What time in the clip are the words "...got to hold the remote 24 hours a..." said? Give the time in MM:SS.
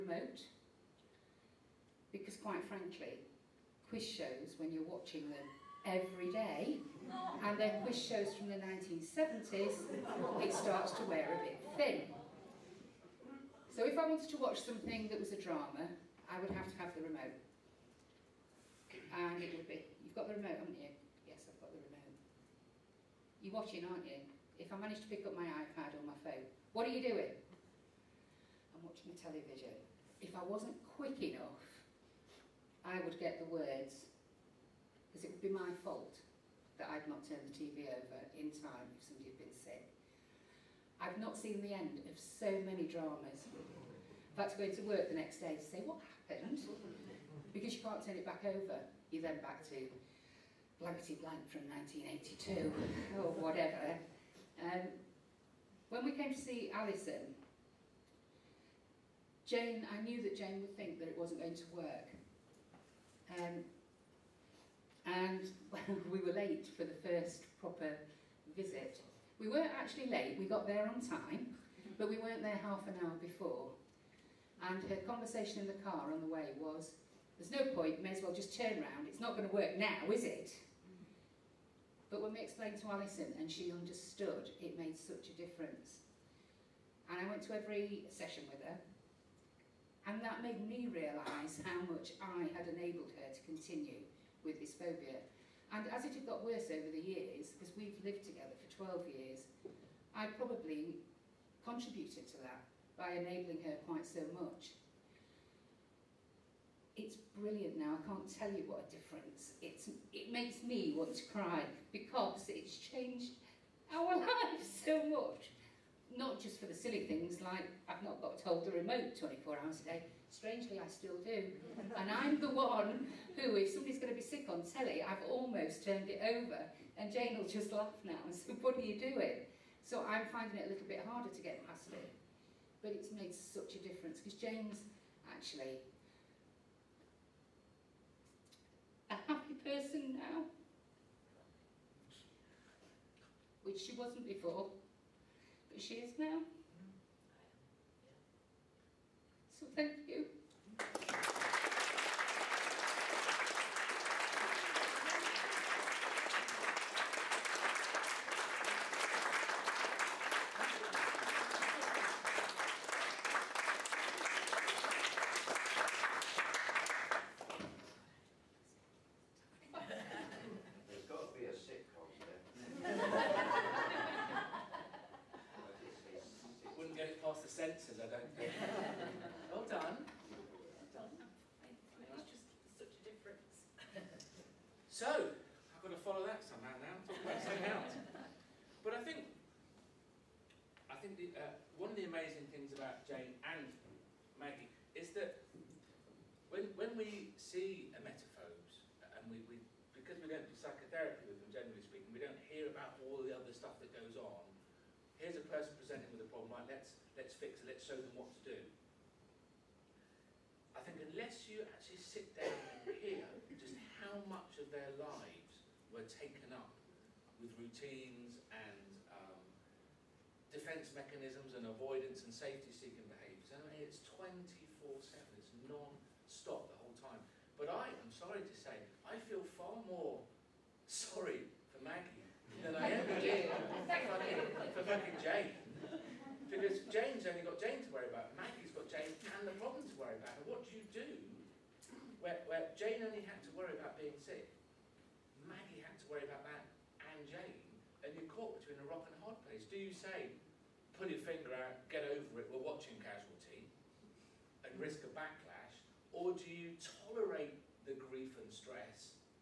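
01:58.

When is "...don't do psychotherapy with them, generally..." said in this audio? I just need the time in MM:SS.
03:20.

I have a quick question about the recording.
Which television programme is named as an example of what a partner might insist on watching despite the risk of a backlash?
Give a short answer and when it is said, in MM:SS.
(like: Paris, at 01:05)
Casualty, at 04:13.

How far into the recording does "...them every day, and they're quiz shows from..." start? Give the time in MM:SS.
00:05.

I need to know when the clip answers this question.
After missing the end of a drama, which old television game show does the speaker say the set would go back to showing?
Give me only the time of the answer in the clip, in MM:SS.
00:50.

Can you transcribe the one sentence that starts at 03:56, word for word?
Because Jane's only got Jane to worry about, Maggie's got Jane and the problem to worry about.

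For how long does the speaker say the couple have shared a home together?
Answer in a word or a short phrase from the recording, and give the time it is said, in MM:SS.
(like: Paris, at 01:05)
12 years, at 01:38.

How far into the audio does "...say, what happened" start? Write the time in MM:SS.
00:45.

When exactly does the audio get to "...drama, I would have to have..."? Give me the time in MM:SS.
00:15.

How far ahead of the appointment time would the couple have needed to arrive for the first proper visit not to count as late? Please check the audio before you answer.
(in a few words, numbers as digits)
half an hour.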